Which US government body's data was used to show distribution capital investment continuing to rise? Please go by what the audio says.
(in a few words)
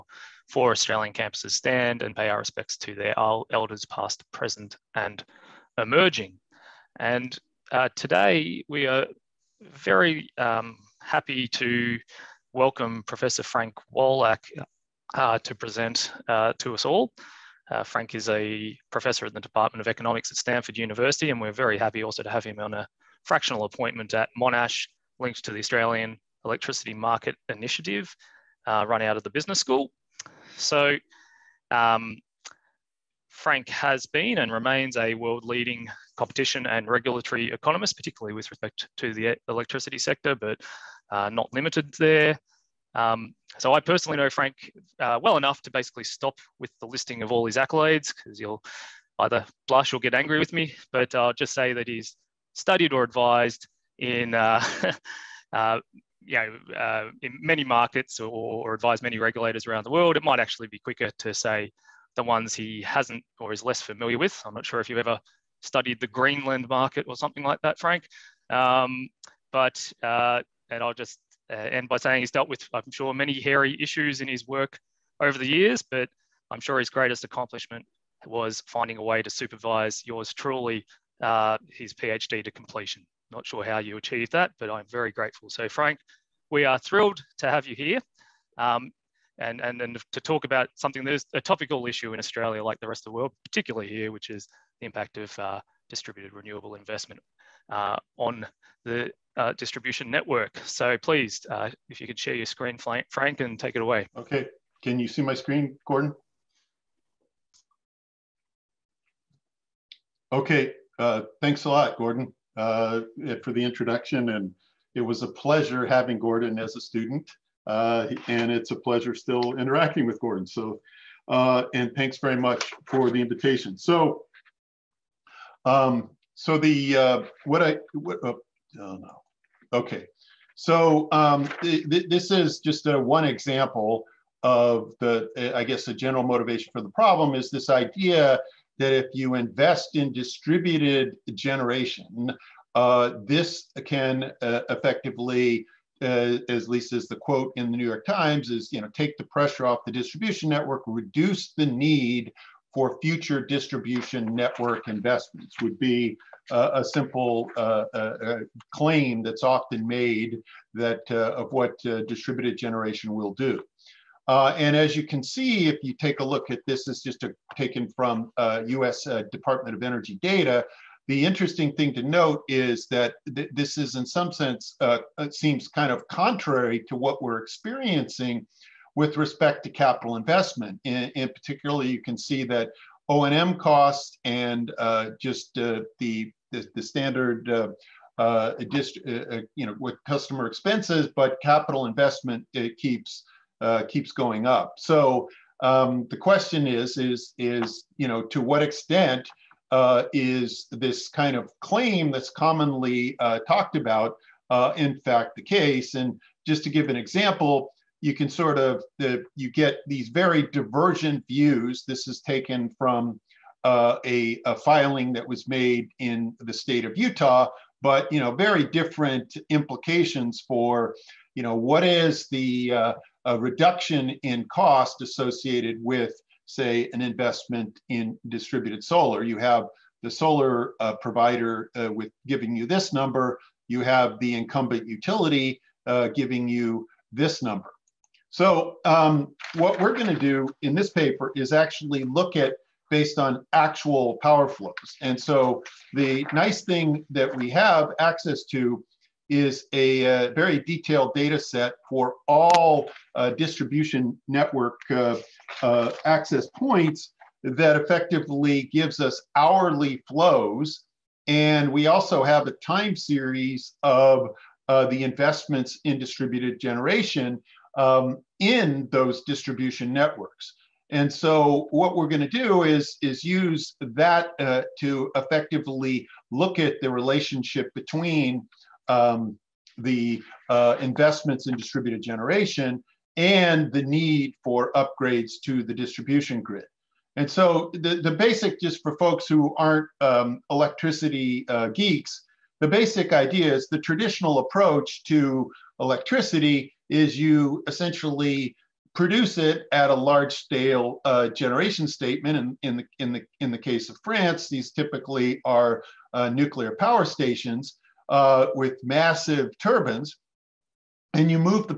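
US Department of Energy.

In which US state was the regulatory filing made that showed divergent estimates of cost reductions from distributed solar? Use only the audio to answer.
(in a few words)
Utah.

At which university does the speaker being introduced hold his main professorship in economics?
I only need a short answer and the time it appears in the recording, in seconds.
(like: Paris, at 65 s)
Stanford University, at 20 s.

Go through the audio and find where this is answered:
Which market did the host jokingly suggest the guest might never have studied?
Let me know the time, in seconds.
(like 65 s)
66 s.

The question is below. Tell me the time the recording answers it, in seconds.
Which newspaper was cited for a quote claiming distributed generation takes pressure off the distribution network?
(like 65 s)
147 s.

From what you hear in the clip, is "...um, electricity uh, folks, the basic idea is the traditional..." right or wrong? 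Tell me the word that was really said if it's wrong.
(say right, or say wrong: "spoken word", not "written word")
wrong: "geeks", not "folks".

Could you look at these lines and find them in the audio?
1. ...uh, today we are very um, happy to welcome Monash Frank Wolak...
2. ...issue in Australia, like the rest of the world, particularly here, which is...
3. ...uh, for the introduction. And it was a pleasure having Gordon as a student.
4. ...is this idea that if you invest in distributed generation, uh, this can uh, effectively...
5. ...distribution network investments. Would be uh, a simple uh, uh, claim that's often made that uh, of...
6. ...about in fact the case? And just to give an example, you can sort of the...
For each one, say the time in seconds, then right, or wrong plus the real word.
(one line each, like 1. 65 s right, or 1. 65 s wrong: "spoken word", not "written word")
1. 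7 s wrong: "Professor", not "Monash"
2. 91 s right
3. 112 s right
4. 137 s right
5. 153 s right
6. 203 s right.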